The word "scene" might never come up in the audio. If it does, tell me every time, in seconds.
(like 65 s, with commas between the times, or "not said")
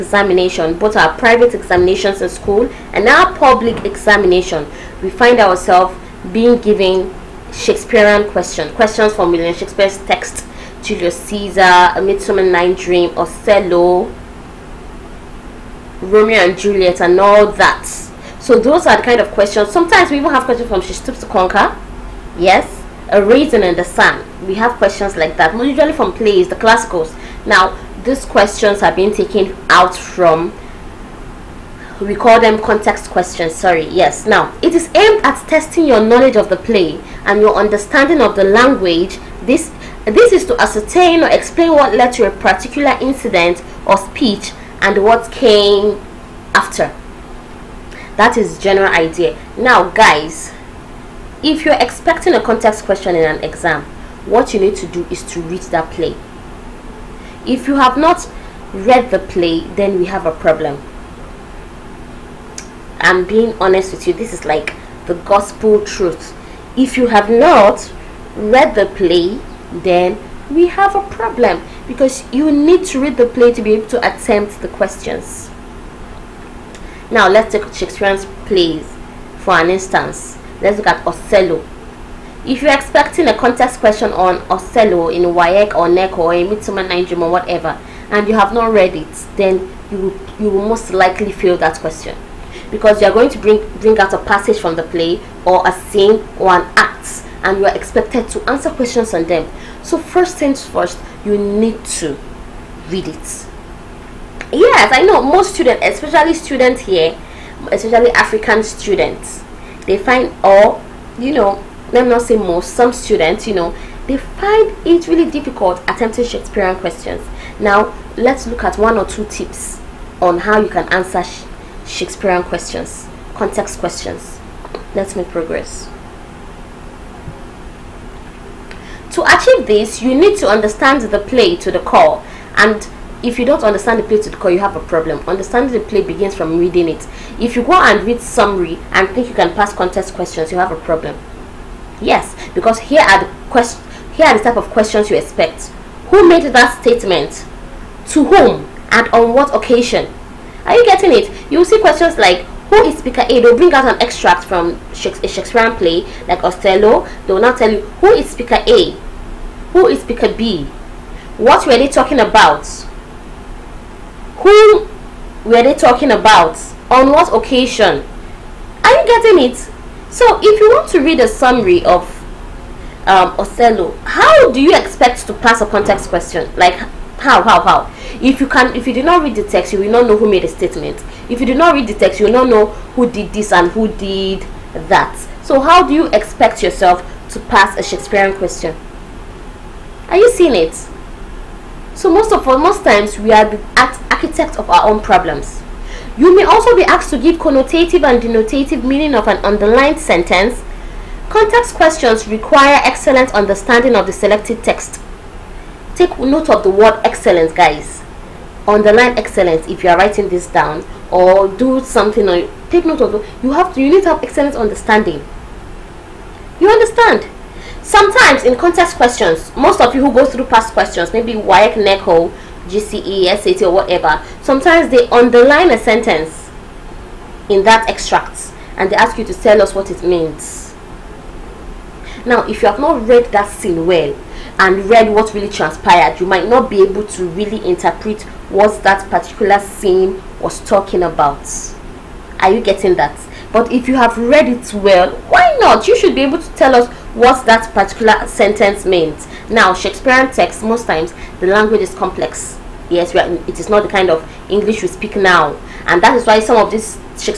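95 s, 233 s, 239 s.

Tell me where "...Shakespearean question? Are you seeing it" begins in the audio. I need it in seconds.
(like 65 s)
187 s.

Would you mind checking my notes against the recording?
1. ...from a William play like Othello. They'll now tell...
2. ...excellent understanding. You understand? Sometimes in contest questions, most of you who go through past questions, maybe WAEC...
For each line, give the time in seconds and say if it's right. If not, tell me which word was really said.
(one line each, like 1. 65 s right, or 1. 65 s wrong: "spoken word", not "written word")
1. 154 s wrong: "Shakespearean", not "William"
2. 214 s right.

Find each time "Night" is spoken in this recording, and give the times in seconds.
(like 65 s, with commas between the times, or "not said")
12 s, 86 s.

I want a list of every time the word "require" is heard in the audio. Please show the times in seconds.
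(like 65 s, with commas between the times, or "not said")
202 s.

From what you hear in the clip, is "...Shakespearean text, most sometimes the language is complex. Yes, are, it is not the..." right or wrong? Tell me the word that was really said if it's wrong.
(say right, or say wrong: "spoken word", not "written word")
wrong: "times", not "sometimes".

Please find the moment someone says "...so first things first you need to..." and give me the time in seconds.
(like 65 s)
99 s.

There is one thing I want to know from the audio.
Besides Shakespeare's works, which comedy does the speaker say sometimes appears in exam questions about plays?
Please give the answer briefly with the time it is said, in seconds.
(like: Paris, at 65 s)
She Stoops to Conquer, at 20 s.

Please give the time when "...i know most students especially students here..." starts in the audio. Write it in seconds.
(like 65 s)
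104 s.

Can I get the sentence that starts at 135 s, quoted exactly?
Understanding the play begins from reading it.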